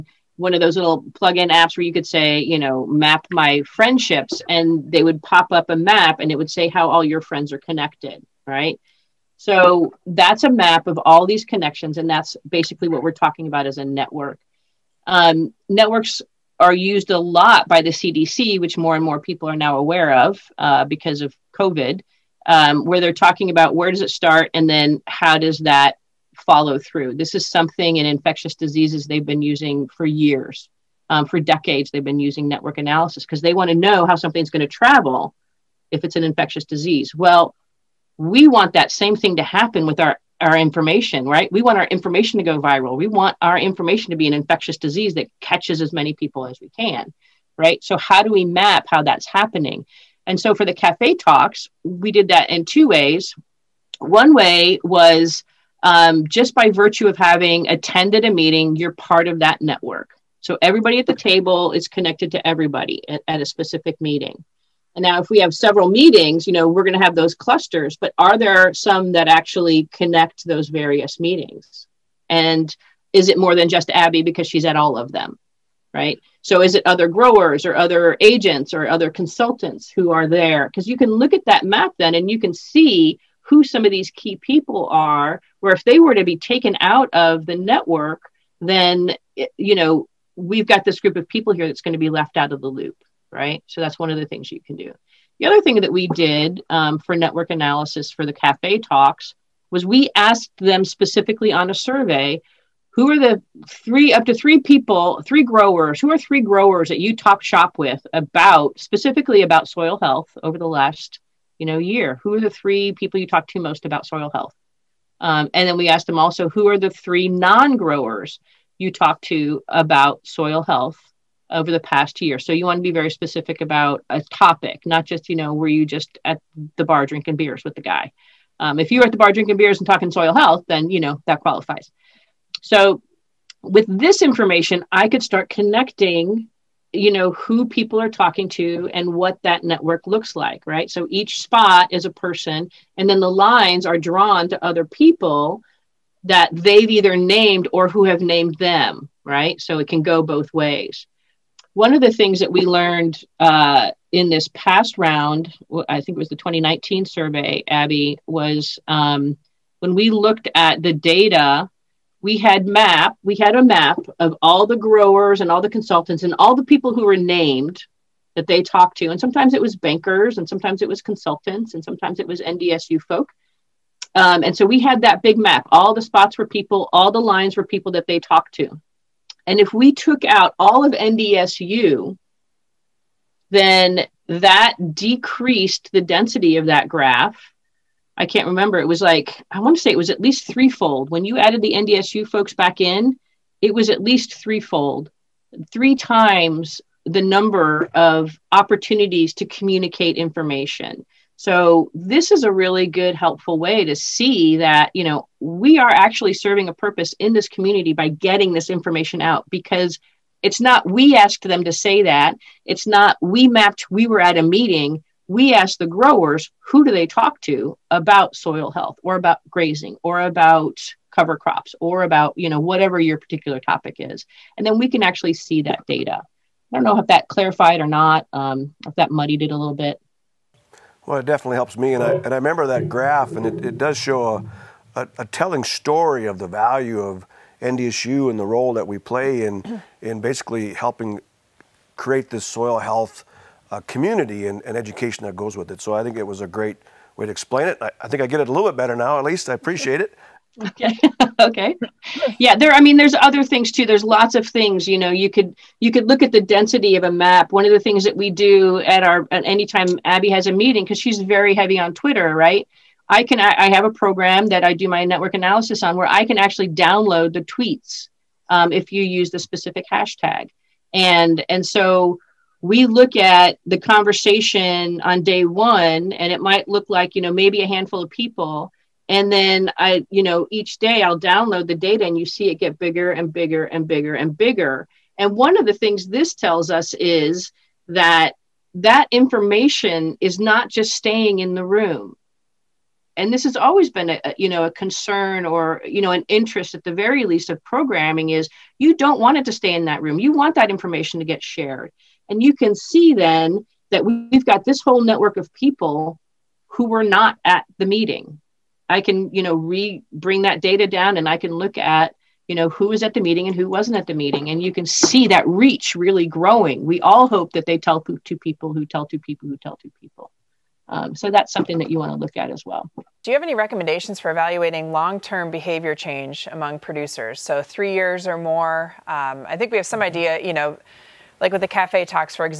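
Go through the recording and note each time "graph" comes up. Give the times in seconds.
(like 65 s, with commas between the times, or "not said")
186 s, 232 s.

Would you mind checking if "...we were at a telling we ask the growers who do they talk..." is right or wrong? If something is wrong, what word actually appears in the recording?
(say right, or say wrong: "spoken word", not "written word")
wrong: "meeting", not "telling".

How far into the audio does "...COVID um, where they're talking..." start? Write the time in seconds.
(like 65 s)
21 s.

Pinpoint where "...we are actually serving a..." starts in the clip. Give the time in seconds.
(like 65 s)
205 s.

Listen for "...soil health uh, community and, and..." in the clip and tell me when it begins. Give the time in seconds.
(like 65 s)
242 s.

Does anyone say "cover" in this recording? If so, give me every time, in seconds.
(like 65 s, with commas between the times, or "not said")
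221 s.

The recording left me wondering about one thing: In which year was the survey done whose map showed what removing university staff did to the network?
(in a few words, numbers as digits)
2019.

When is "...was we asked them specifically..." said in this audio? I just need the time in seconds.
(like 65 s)
99 s.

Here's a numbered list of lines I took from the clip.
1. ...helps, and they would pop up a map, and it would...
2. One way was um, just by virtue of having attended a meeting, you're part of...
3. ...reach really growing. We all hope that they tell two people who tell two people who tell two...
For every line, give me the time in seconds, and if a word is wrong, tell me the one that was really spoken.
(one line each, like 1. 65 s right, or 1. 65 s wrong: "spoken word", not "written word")
1. 3 s wrong: "friendships", not "helps"
2. 53 s right
3. 315 s right.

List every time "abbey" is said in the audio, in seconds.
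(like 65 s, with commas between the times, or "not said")
73 s, 157 s, 260 s.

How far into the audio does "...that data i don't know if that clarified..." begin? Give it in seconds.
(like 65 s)
225 s.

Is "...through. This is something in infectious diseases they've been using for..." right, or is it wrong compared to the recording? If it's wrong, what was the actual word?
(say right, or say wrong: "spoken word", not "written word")
right.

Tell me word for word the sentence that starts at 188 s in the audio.
It was like, I want to say it was at least threefold.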